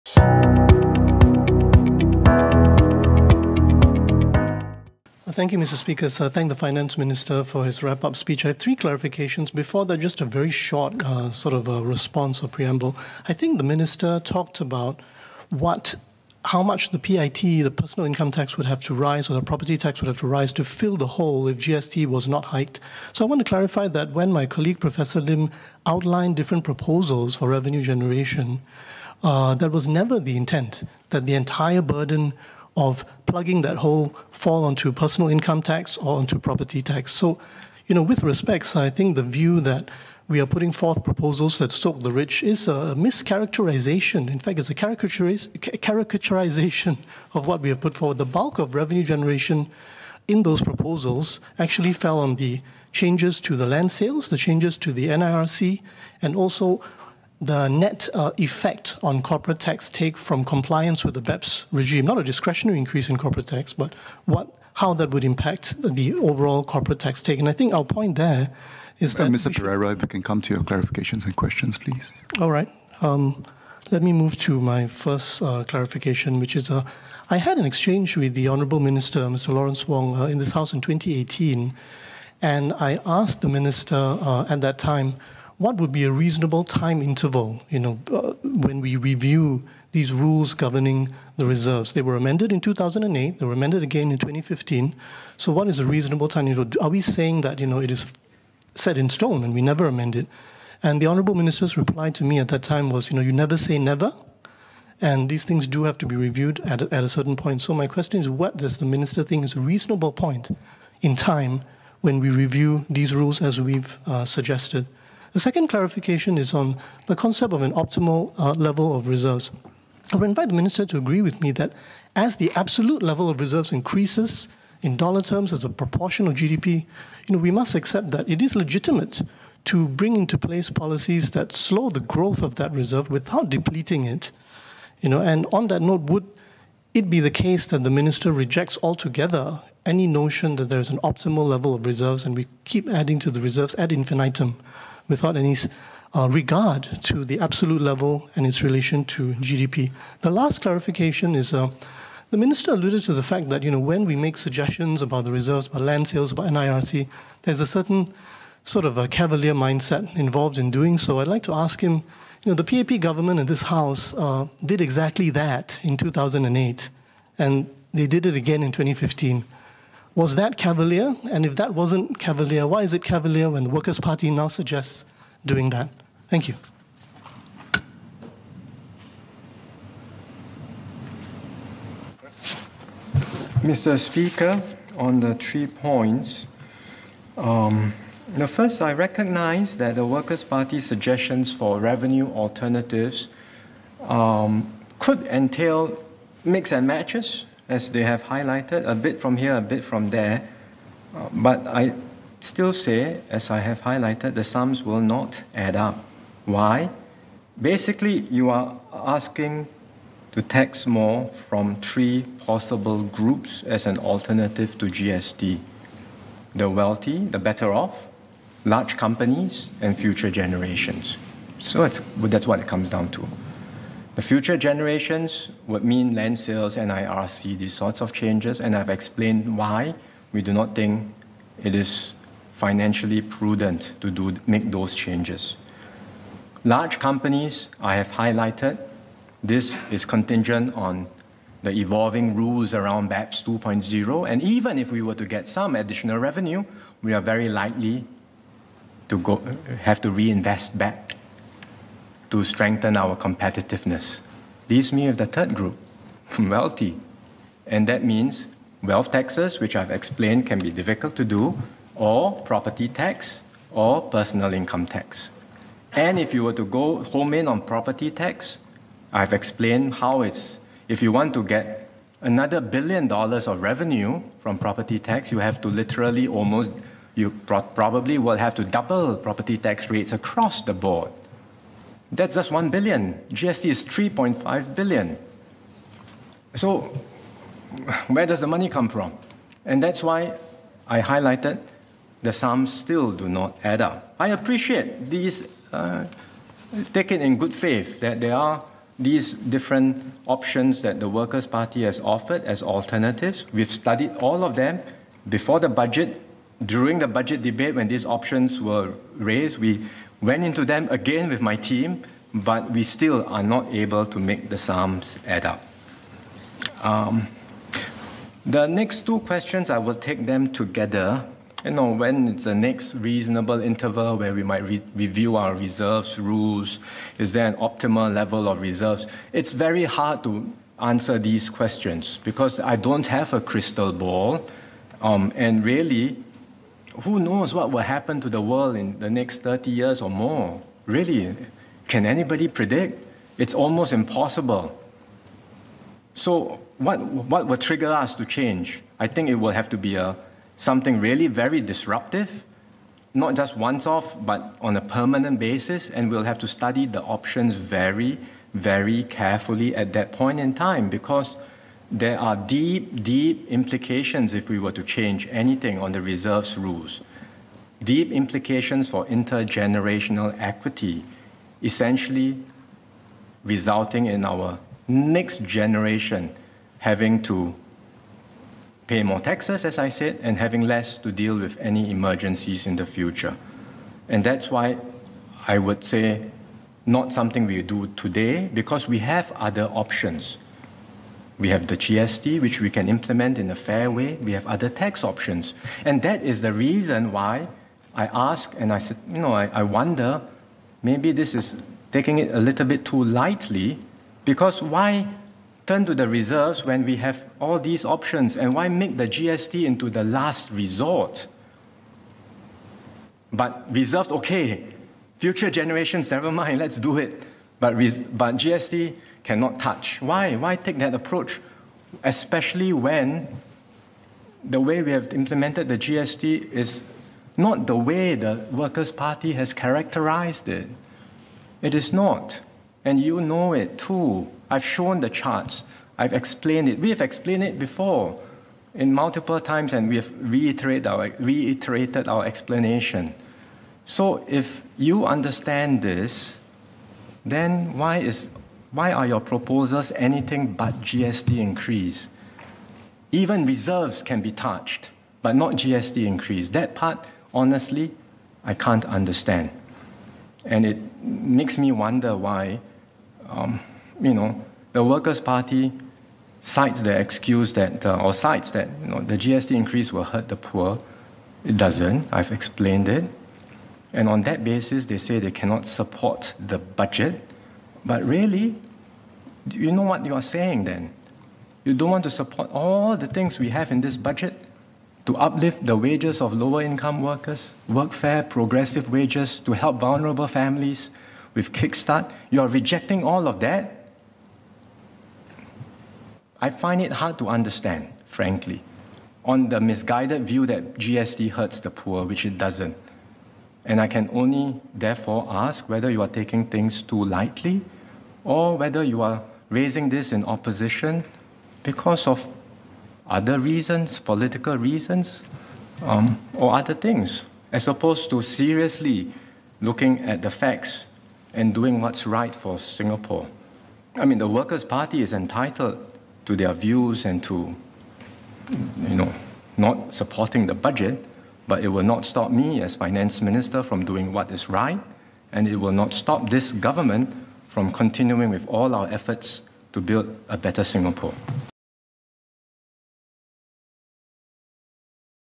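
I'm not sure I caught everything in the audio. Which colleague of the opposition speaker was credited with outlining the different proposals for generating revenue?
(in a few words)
Professor Lim.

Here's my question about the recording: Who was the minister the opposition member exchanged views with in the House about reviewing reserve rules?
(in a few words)
Lawrence Wong.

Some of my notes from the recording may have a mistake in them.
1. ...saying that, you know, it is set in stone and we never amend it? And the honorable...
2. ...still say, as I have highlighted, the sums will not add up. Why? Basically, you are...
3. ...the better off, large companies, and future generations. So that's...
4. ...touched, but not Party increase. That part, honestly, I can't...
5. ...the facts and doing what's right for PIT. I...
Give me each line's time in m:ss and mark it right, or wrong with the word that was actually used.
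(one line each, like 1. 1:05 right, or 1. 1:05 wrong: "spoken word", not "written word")
1. 1:36 right
2. 3:22 right
3. 3:37 right
4. 7:34 wrong: "GST", not "Party"
5. 8:40 wrong: "Singapore", not "PIT".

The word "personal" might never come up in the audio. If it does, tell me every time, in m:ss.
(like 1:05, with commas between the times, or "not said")
0:17, 0:34, 4:24.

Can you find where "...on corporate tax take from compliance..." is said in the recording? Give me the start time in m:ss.
0:59.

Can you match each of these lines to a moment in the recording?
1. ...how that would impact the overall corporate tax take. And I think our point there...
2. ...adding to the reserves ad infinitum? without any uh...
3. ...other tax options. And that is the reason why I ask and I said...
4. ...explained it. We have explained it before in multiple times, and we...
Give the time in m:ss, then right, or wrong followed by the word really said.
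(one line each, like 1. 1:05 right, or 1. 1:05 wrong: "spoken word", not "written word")
1. 1:04 right
2. 2:22 right
3. 6:34 right
4. 7:16 right.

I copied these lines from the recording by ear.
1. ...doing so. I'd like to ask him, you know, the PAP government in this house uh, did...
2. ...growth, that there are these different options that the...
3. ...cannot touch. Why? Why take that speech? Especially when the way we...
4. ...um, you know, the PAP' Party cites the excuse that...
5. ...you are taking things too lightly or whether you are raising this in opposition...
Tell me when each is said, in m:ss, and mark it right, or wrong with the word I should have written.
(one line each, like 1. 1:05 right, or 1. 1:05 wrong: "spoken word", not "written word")
1. 2:40 right
2. 4:57 wrong: "faith", not "growth"
3. 6:59 wrong: "approach", not "speech"
4. 7:43 wrong: "Workers", not "PAP"
5. 8:25 right.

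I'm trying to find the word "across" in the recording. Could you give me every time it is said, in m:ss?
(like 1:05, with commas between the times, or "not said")
4:40.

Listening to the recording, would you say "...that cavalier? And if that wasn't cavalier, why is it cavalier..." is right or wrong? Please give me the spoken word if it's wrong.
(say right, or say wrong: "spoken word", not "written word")
right.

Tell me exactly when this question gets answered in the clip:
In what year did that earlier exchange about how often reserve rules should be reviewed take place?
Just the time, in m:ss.
1:20.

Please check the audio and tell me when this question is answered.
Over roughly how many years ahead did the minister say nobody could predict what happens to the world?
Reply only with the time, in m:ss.
5:39.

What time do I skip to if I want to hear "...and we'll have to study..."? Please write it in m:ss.
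5:55.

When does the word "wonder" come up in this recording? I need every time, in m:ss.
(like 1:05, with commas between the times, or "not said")
6:39, 7:41.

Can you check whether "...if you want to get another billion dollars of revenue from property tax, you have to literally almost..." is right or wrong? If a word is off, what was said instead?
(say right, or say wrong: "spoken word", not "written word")
right.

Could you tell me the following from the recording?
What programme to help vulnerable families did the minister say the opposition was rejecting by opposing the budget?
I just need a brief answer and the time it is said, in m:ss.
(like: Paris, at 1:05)
KidSTART, at 8:11.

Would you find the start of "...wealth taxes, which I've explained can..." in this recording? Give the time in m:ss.
4:18.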